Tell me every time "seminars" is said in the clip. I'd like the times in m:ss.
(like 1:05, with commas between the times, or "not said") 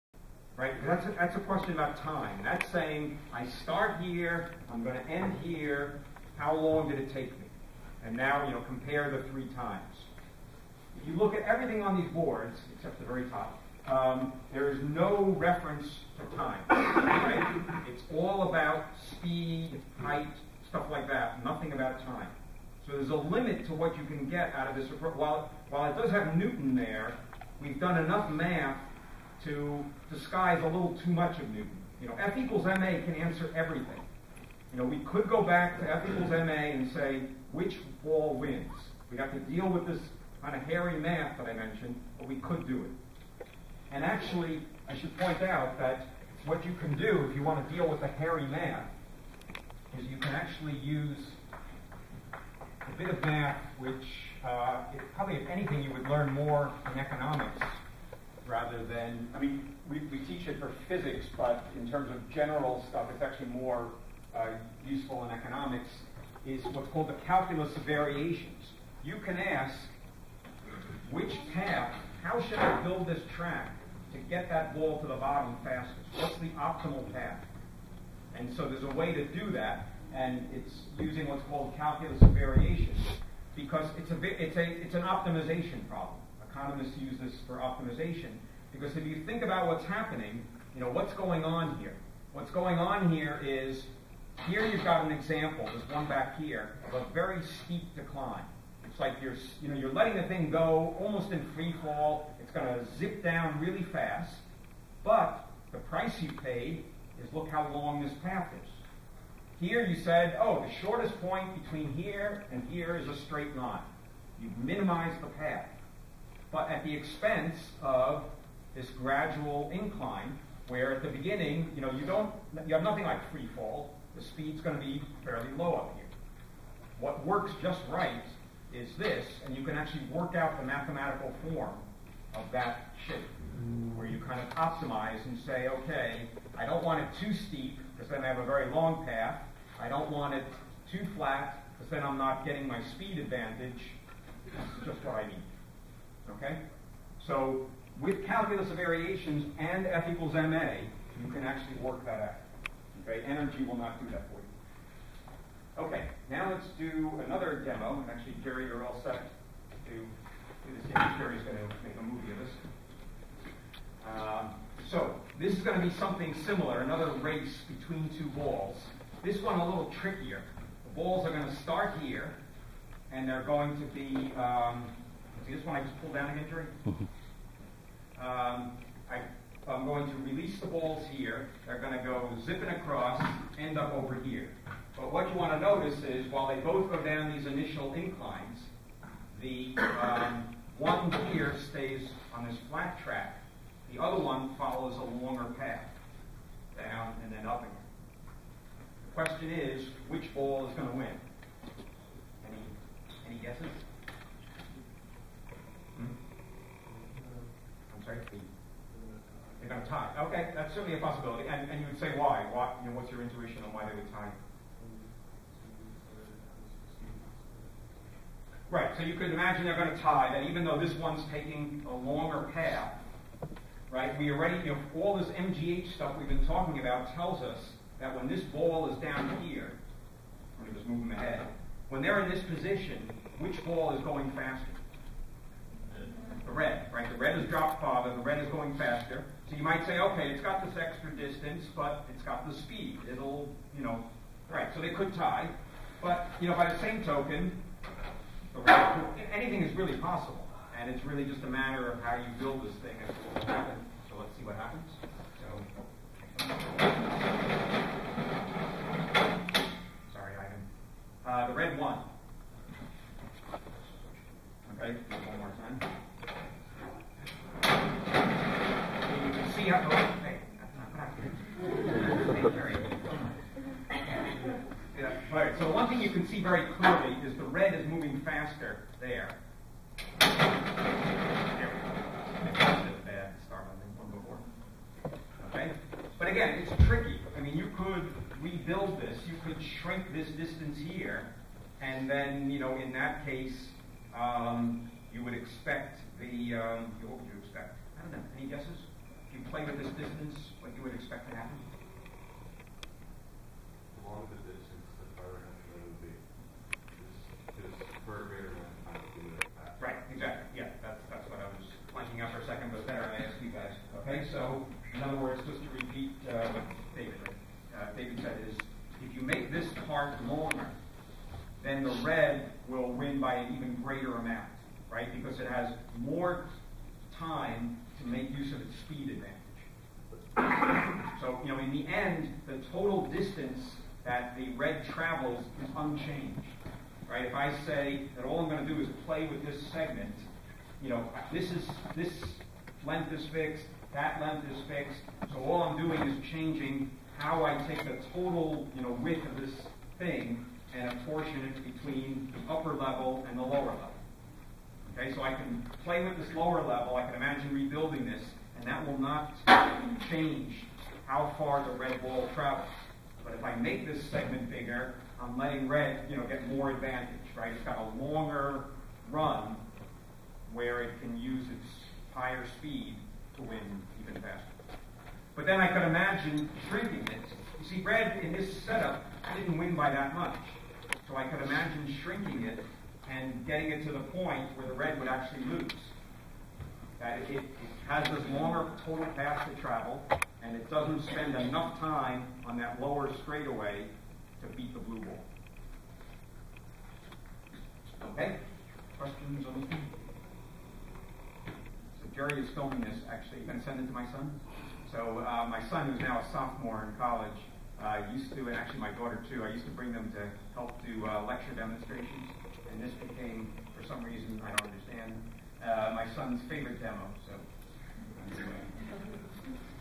not said.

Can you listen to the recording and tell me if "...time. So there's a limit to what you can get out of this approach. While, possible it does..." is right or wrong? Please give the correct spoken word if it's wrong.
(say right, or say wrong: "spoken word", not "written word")
wrong: "while", not "possible".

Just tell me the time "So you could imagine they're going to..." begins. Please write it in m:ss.
3:38.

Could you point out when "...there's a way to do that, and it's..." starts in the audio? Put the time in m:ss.
1:18.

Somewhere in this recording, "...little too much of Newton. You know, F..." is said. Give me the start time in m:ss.
0:30.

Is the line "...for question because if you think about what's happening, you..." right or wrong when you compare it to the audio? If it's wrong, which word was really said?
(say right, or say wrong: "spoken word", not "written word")
wrong: "optimization", not "question".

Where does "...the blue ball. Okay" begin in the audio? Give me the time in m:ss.
6:34.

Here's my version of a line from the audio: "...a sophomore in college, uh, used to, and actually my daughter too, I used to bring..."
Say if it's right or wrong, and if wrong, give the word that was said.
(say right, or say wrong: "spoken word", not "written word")
right.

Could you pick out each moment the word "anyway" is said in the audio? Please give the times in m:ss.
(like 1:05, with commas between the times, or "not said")
6:58.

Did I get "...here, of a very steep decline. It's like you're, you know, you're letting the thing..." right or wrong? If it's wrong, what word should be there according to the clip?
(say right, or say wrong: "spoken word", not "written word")
right.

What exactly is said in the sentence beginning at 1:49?
Here you said, oh, the shortest point between here and here is a straight line.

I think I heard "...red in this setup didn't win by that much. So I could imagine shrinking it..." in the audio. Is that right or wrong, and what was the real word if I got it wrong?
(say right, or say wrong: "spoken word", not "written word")
right.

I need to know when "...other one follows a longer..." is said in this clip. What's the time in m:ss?
3:14.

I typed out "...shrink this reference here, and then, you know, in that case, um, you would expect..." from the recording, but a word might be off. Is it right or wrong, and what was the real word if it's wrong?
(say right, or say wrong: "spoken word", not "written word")
wrong: "distance", not "reference".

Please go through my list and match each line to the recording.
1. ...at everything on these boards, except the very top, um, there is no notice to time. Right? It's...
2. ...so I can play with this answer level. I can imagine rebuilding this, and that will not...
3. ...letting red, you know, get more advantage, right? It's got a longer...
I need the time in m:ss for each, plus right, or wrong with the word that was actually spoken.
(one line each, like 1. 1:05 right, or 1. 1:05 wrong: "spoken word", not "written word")
1. 0:11 wrong: "reference", not "notice"
2. 5:55 wrong: "lower", not "answer"
3. 6:05 right.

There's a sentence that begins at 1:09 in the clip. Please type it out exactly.
You can ask, which path, how should I build this track to get that ball to the bottom fastest?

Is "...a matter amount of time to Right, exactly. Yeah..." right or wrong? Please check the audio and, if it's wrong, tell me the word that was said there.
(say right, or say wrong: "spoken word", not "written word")
wrong: "greater", not "matter".